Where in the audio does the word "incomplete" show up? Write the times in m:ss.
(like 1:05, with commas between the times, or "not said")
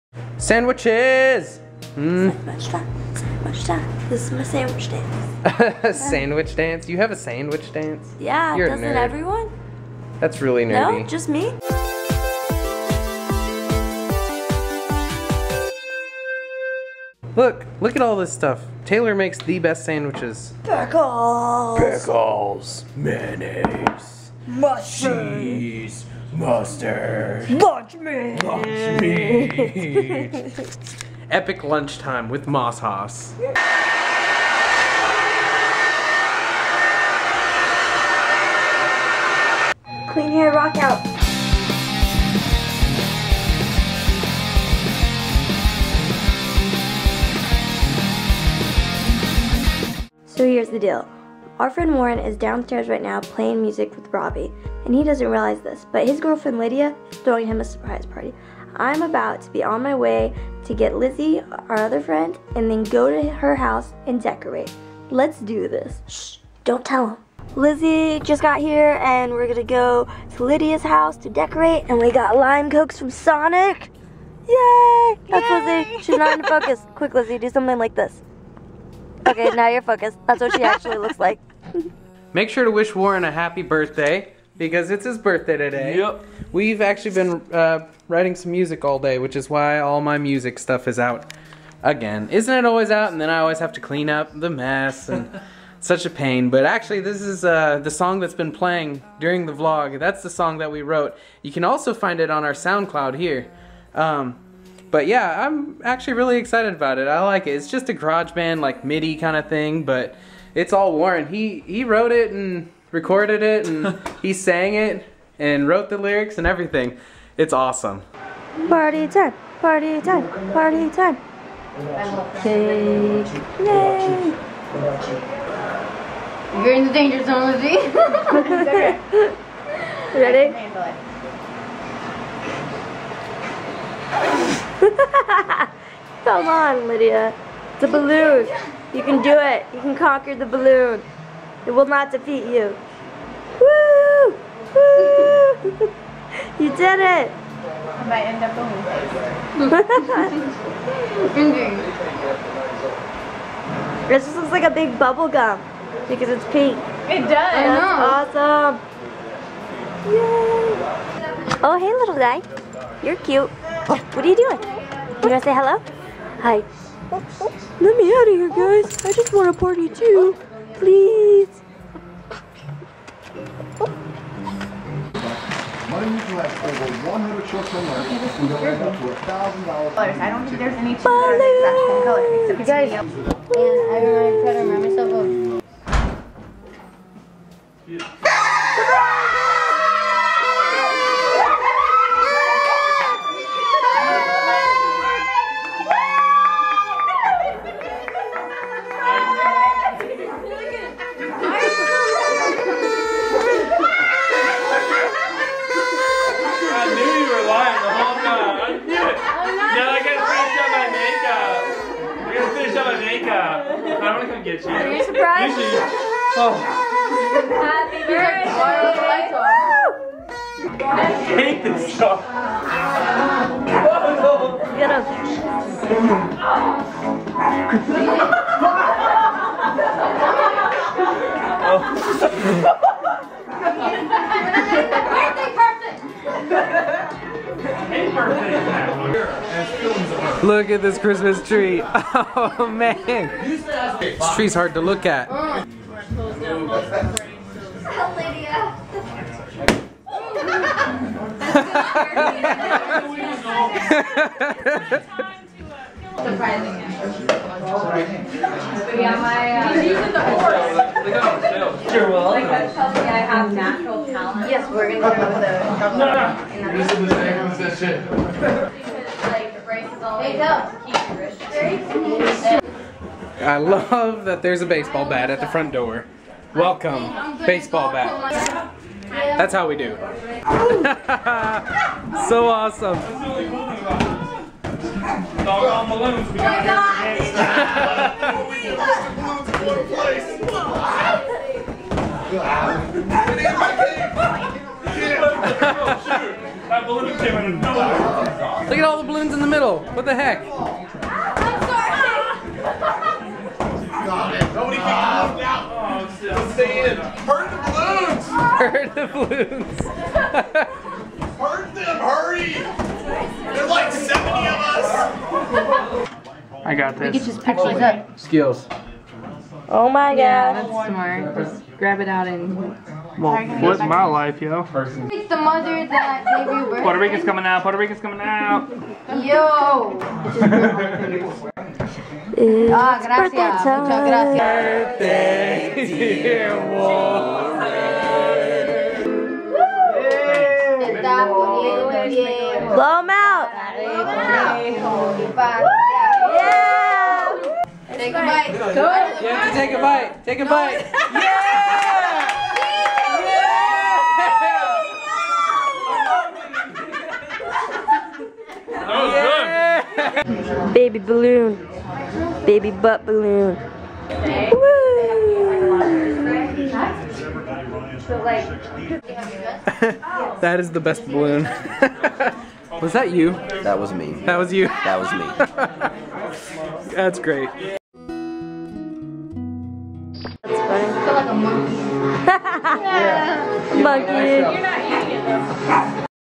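not said.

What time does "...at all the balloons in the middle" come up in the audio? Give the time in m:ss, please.
4:58.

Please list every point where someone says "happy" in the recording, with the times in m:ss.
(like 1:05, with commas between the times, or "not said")
1:23, 3:37.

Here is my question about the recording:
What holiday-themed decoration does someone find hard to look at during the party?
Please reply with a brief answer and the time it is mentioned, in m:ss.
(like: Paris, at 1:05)
Christmas tree, at 4:00.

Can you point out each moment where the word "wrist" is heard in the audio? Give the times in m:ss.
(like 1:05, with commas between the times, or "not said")
4:31.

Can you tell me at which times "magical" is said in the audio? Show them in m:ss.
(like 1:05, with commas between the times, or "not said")
not said.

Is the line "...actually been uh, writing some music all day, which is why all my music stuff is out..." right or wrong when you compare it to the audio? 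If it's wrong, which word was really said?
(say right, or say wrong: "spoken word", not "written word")
right.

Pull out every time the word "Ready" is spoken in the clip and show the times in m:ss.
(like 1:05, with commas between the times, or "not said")
2:10.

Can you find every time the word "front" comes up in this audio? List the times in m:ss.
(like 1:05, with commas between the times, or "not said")
4:35.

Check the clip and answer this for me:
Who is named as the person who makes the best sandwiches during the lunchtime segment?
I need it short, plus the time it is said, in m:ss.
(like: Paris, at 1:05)
Taylor, at 0:18.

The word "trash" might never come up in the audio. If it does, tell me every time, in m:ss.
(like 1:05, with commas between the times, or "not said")
not said.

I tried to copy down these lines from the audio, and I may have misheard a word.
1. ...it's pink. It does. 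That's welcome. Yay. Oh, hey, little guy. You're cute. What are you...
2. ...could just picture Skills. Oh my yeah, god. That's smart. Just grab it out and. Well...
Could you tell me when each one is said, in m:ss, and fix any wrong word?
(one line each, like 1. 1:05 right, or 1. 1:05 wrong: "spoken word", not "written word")
1. 2:36 wrong: "awesome", not "welcome"
2. 5:17 right.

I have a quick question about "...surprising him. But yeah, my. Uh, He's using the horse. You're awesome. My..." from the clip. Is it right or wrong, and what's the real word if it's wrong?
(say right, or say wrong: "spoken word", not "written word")
wrong: "welcome", not "awesome".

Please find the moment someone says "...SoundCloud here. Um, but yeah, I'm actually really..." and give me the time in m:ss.
1:42.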